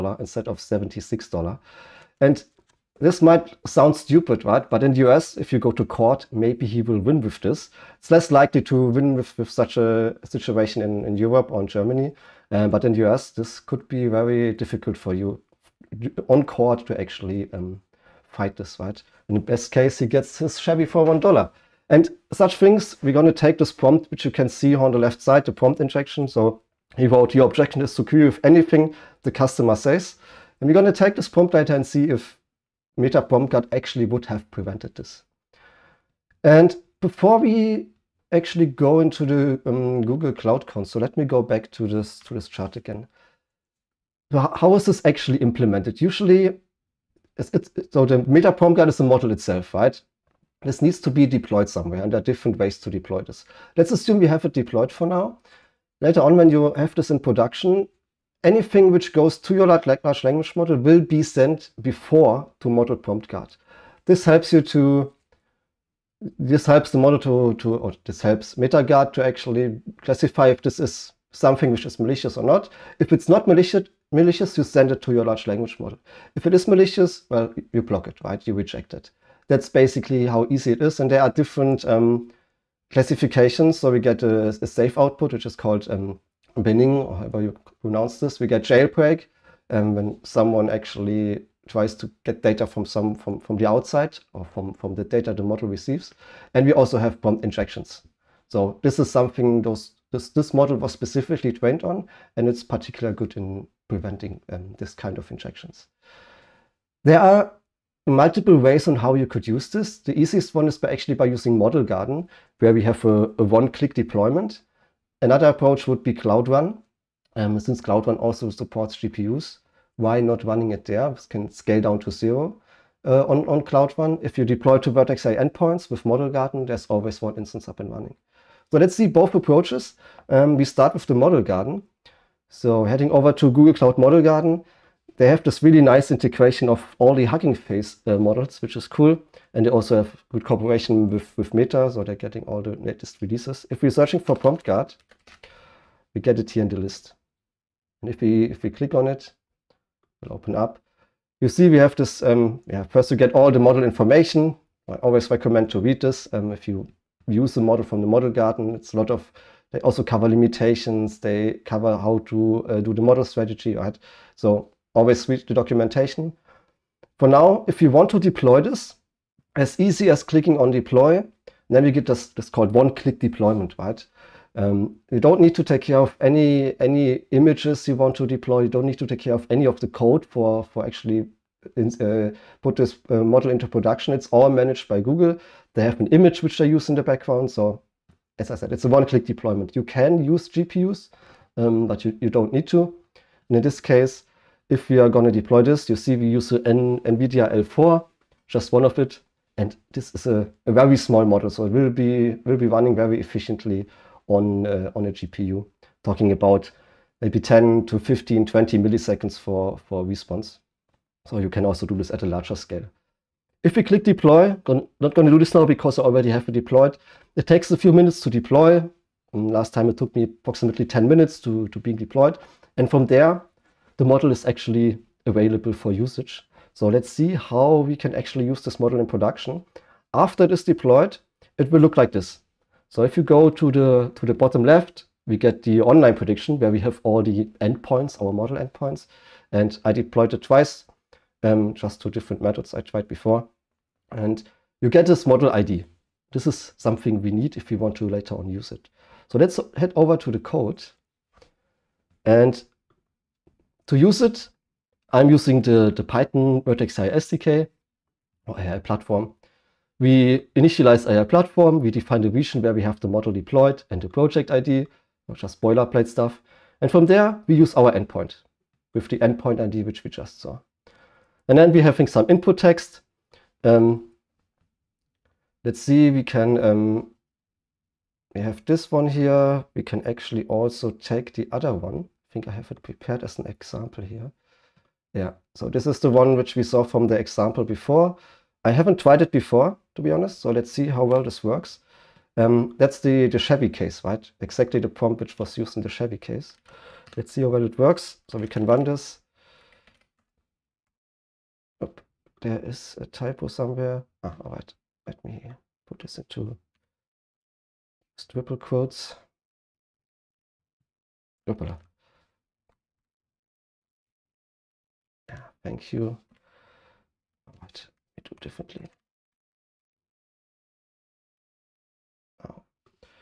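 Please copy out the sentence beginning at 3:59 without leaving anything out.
And I deployed it twice, um, just two different methods I tried before.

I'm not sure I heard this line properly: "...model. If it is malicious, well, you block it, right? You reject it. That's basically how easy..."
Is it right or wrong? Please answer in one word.
right.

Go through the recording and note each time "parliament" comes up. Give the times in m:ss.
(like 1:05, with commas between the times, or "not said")
not said.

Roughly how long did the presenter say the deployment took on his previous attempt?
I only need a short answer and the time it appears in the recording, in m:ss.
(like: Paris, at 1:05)
10 minutes, at 3:40.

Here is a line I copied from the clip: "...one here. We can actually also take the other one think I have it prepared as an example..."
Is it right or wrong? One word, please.
right.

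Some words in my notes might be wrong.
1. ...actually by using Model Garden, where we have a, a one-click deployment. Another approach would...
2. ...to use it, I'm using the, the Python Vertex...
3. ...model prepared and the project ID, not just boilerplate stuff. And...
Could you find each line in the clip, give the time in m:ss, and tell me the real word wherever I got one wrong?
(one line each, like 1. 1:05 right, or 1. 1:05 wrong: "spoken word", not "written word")
1. 1:50 right
2. 4:13 right
3. 4:23 wrong: "deployed", not "prepared".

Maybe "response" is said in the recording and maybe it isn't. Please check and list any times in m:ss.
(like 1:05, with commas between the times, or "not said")
3:30.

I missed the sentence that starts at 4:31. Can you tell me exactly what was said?
And then we're having some input text.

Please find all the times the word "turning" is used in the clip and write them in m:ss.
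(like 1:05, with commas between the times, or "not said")
not said.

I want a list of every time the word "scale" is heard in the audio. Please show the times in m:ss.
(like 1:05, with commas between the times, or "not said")
2:01, 3:32.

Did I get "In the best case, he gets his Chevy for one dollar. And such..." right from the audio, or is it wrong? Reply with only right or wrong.
right.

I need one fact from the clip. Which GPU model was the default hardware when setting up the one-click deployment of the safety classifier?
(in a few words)
NVIDIA L4.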